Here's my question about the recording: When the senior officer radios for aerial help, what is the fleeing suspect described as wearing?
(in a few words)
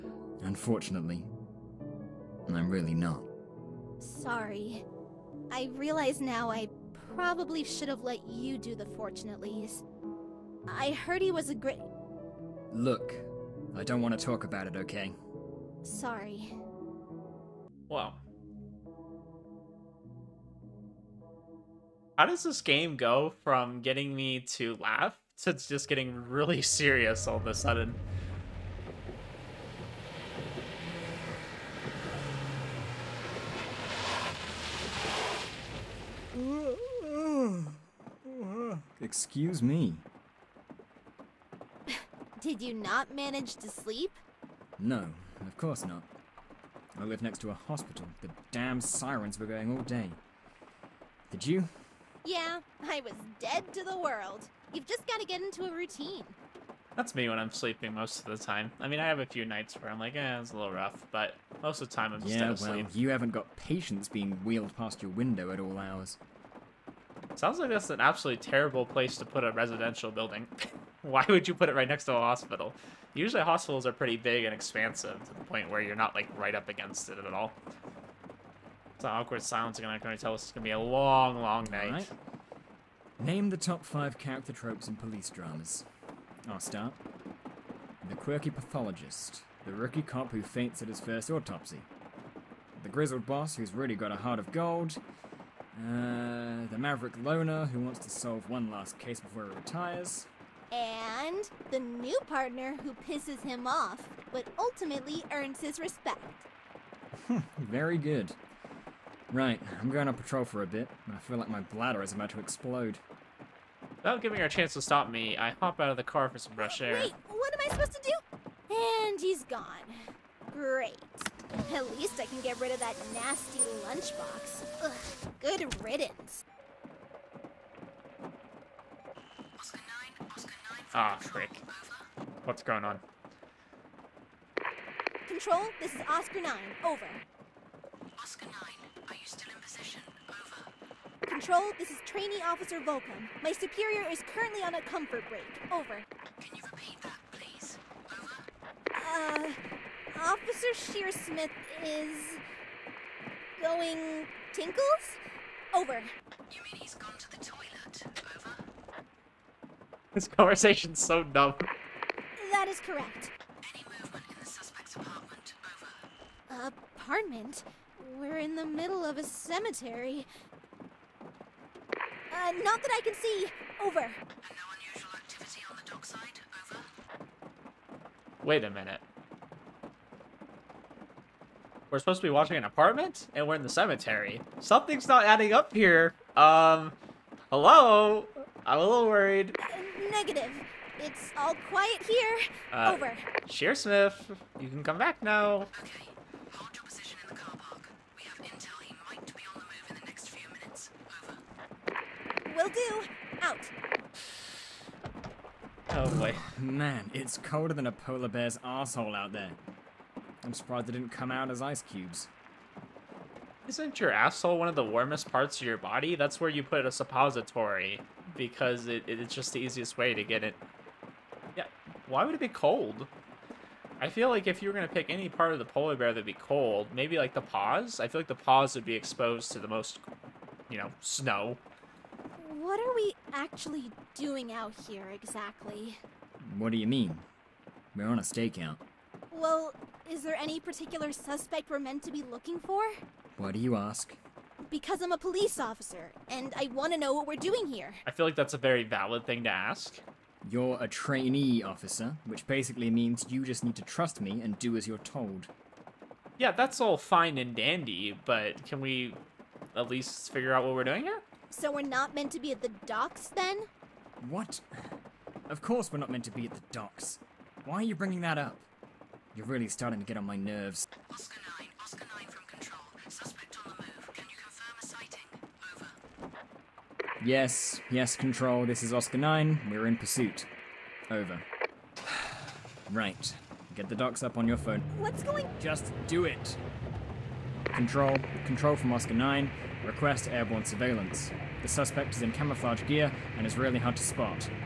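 Camouflage gear.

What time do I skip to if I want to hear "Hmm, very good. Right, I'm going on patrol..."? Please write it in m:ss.
1:47.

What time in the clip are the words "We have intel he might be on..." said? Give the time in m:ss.
3:18.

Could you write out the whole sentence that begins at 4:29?
You're really starting to get on my nerves.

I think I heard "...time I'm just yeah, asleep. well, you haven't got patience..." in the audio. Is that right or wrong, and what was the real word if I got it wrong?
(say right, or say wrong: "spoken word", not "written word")
right.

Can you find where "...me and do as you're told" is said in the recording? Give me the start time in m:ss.
4:14.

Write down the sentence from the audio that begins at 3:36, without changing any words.
That's where you put a suppository because it, it's just the easiest way to get it.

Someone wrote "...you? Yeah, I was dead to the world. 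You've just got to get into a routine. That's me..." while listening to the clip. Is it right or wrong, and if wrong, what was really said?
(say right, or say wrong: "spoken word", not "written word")
right.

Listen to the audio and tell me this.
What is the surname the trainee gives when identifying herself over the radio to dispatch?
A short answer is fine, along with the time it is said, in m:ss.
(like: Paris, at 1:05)
Volkham, at 2:22.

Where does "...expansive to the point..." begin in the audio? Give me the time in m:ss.
1:14.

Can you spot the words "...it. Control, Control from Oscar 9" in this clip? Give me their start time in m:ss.
4:46.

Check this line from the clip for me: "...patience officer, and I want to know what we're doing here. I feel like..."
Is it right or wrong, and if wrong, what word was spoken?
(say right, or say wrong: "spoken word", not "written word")
wrong: "police", not "patience".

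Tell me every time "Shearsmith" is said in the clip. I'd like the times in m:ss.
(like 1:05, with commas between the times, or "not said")
2:30, 3:13.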